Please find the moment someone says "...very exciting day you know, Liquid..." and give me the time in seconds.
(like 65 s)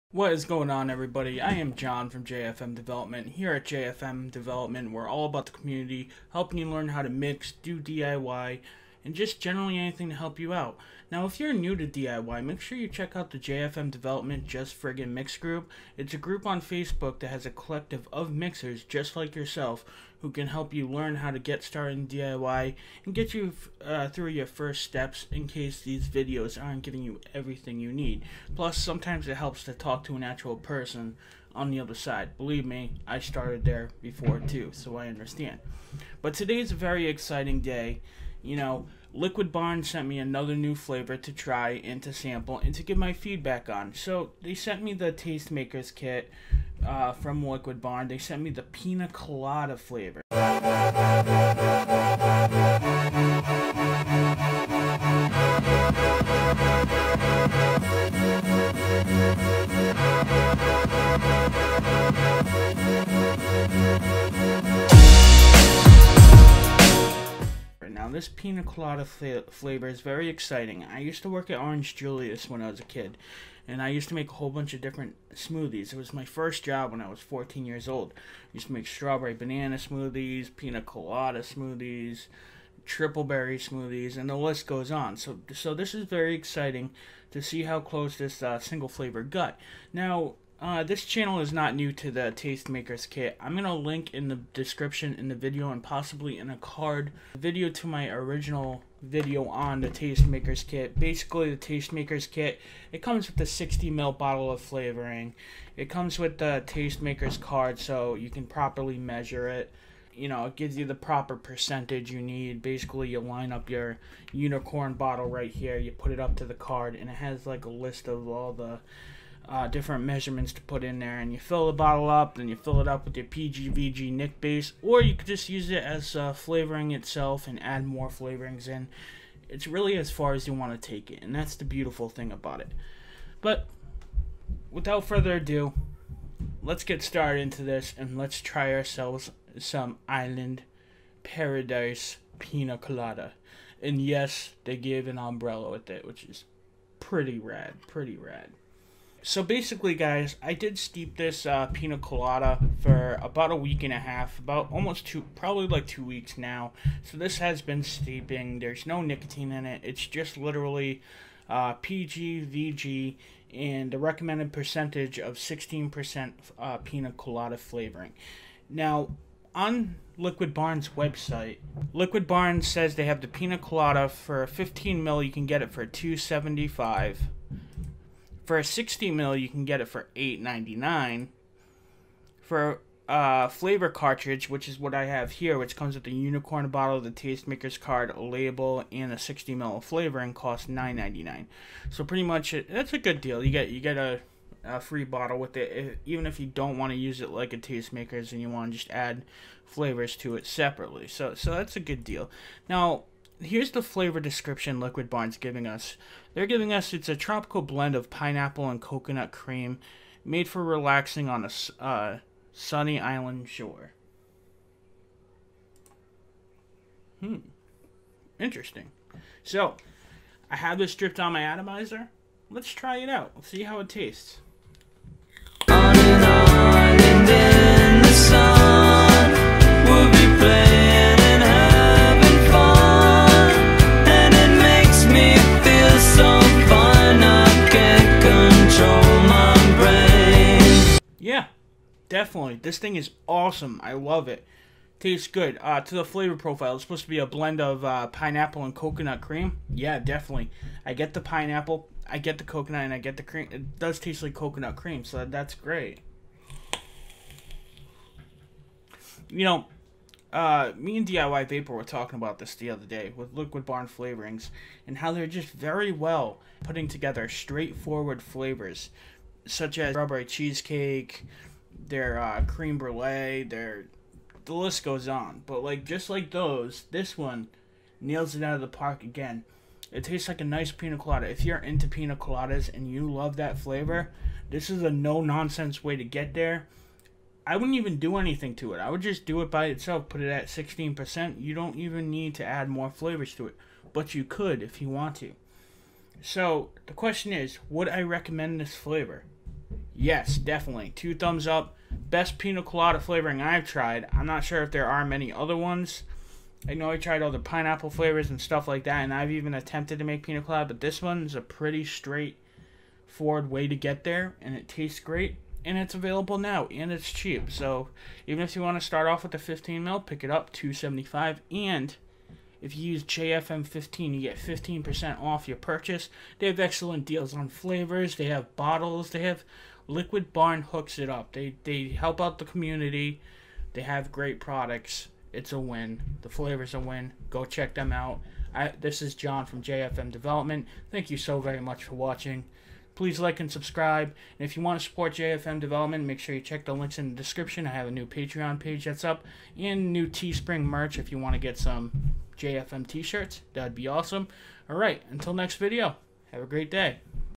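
36 s.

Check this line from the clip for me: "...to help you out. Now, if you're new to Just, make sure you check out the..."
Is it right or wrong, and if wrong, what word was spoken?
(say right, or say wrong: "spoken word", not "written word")
wrong: "DIY", not "Just".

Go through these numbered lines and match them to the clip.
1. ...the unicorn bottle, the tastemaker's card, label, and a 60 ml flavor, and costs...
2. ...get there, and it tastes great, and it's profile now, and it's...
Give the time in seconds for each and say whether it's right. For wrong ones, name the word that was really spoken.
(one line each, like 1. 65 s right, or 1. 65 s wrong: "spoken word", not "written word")
1. 186 s right
2. 313 s wrong: "available", not "profile".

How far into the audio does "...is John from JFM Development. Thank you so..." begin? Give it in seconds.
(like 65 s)
339 s.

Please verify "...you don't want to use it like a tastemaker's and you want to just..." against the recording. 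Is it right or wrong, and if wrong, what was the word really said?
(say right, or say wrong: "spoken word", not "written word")
right.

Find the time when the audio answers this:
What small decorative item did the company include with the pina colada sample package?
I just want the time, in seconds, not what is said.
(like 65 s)
145 s.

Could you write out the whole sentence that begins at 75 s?
It was my first job when I was 14 years old.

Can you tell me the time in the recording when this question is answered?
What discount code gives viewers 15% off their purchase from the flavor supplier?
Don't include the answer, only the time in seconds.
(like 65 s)
323 s.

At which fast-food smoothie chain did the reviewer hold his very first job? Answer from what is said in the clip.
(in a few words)
Orange Julius.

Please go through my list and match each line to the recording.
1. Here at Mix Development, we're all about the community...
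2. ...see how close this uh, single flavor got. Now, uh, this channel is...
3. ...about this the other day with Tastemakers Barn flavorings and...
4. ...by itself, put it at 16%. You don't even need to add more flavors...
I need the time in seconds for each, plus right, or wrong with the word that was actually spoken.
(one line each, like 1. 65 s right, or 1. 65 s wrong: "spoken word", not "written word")
1. 3 s wrong: "JFM", not "Mix"
2. 87 s right
3. 262 s wrong: "Liquid", not "Tastemakers"
4. 289 s right.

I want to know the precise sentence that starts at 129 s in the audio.
It's really as far as you want to take it, and that's the beautiful thing about it.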